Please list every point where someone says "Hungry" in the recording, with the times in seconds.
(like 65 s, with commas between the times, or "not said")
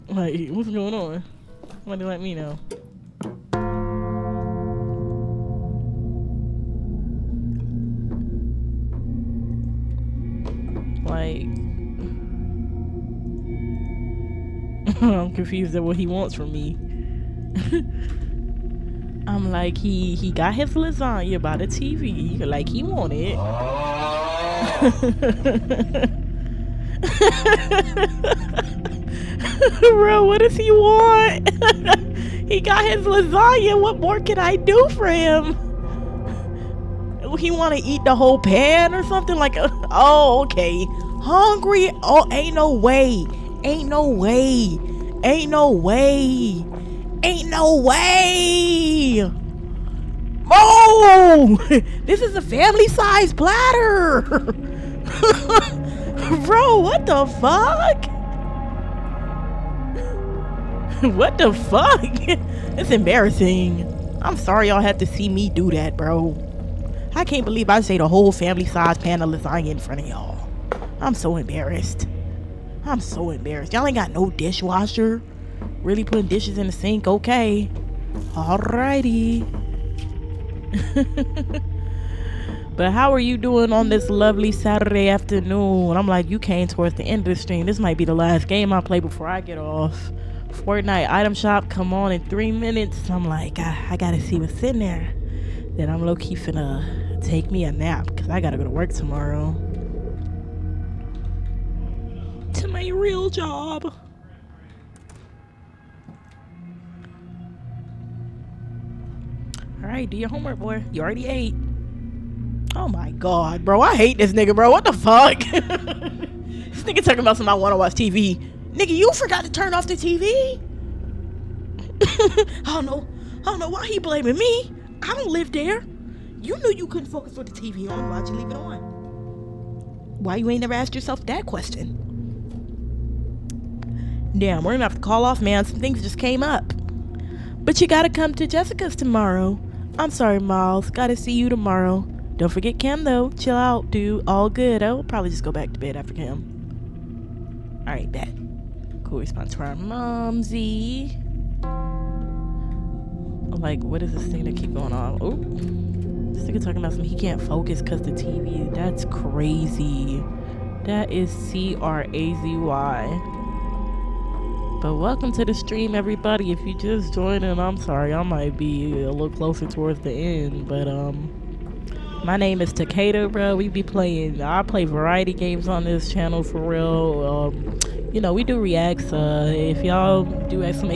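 41 s.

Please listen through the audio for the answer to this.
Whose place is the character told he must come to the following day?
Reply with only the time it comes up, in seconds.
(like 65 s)
138 s.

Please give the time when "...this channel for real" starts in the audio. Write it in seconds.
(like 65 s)
175 s.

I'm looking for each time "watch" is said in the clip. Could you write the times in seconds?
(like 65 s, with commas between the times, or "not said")
117 s.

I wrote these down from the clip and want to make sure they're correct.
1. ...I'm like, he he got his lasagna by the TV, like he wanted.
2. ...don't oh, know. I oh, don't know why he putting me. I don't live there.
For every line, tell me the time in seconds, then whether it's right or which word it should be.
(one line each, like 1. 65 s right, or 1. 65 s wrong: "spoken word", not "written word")
1. 19 s right
2. 122 s wrong: "blaming", not "putting".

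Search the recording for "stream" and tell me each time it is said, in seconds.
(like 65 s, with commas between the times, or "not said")
87 s, 165 s.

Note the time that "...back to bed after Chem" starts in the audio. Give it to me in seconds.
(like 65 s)
145 s.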